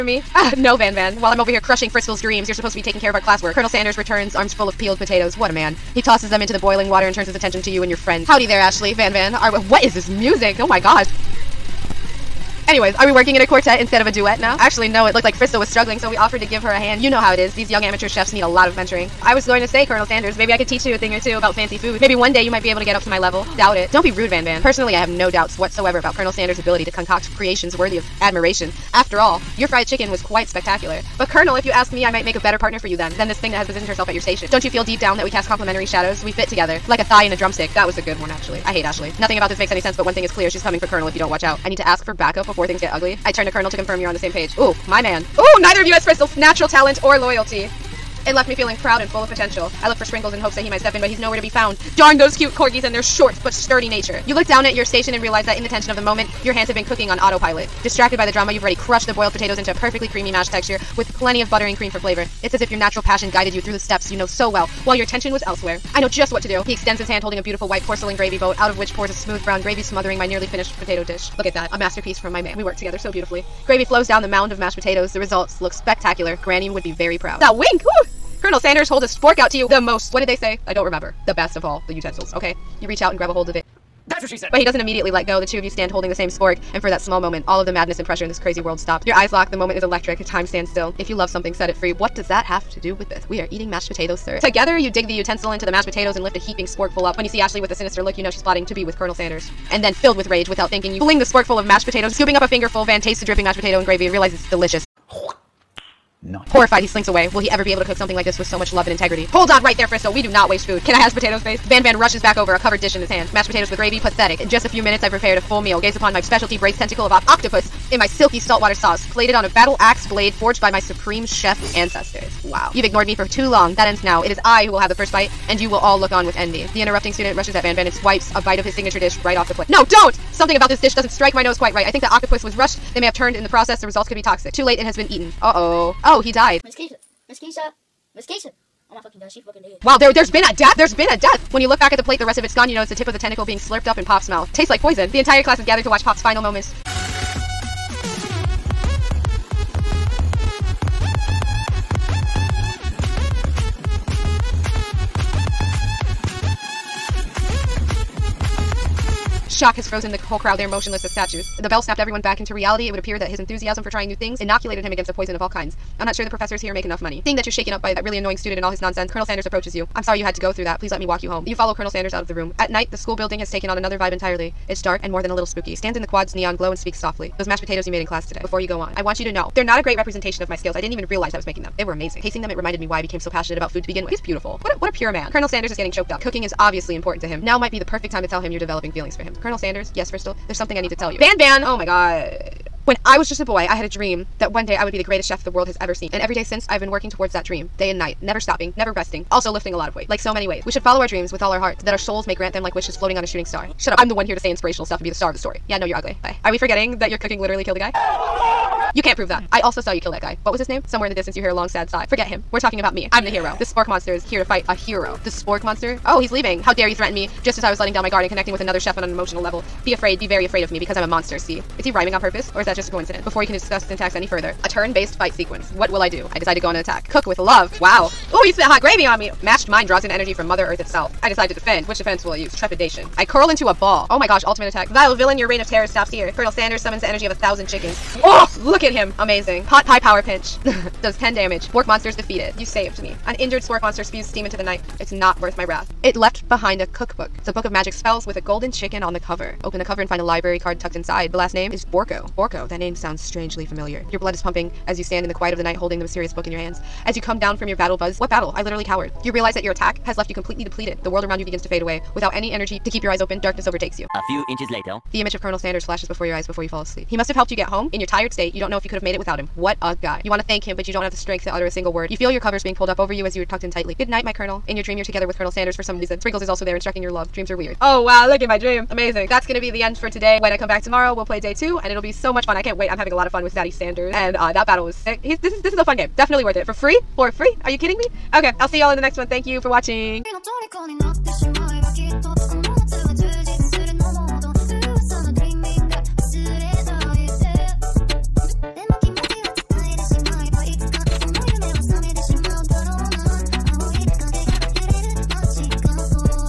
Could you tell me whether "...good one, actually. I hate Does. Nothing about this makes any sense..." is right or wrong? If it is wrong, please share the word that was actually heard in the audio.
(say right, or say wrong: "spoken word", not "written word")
wrong: "Ashley", not "Does".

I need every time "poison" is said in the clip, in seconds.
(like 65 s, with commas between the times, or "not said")
144 s, 165 s.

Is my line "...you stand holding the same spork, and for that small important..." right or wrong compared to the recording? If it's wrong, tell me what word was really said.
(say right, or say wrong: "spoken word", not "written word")
wrong: "moment", not "important".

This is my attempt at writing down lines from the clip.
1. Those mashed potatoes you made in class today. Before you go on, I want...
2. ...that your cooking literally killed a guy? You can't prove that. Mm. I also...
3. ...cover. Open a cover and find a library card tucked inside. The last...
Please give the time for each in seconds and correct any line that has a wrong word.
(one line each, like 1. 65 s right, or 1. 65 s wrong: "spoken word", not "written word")
1. 177 s right
2. 206 s right
3. 249 s right.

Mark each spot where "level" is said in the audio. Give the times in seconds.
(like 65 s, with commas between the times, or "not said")
23 s, 219 s.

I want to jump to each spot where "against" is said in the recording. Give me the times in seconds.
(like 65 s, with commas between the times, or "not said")
164 s.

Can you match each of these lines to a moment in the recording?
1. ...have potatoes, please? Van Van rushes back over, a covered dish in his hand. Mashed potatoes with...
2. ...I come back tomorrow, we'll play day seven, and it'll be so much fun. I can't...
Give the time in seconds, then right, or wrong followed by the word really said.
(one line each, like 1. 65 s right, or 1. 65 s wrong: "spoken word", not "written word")
1. 110 s right
2. 280 s wrong: "two", not "seven".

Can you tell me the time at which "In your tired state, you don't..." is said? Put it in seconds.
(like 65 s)
267 s.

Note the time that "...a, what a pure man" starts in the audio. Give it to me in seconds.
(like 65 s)
184 s.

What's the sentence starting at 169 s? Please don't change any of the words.
I'm sorry you had to go through that.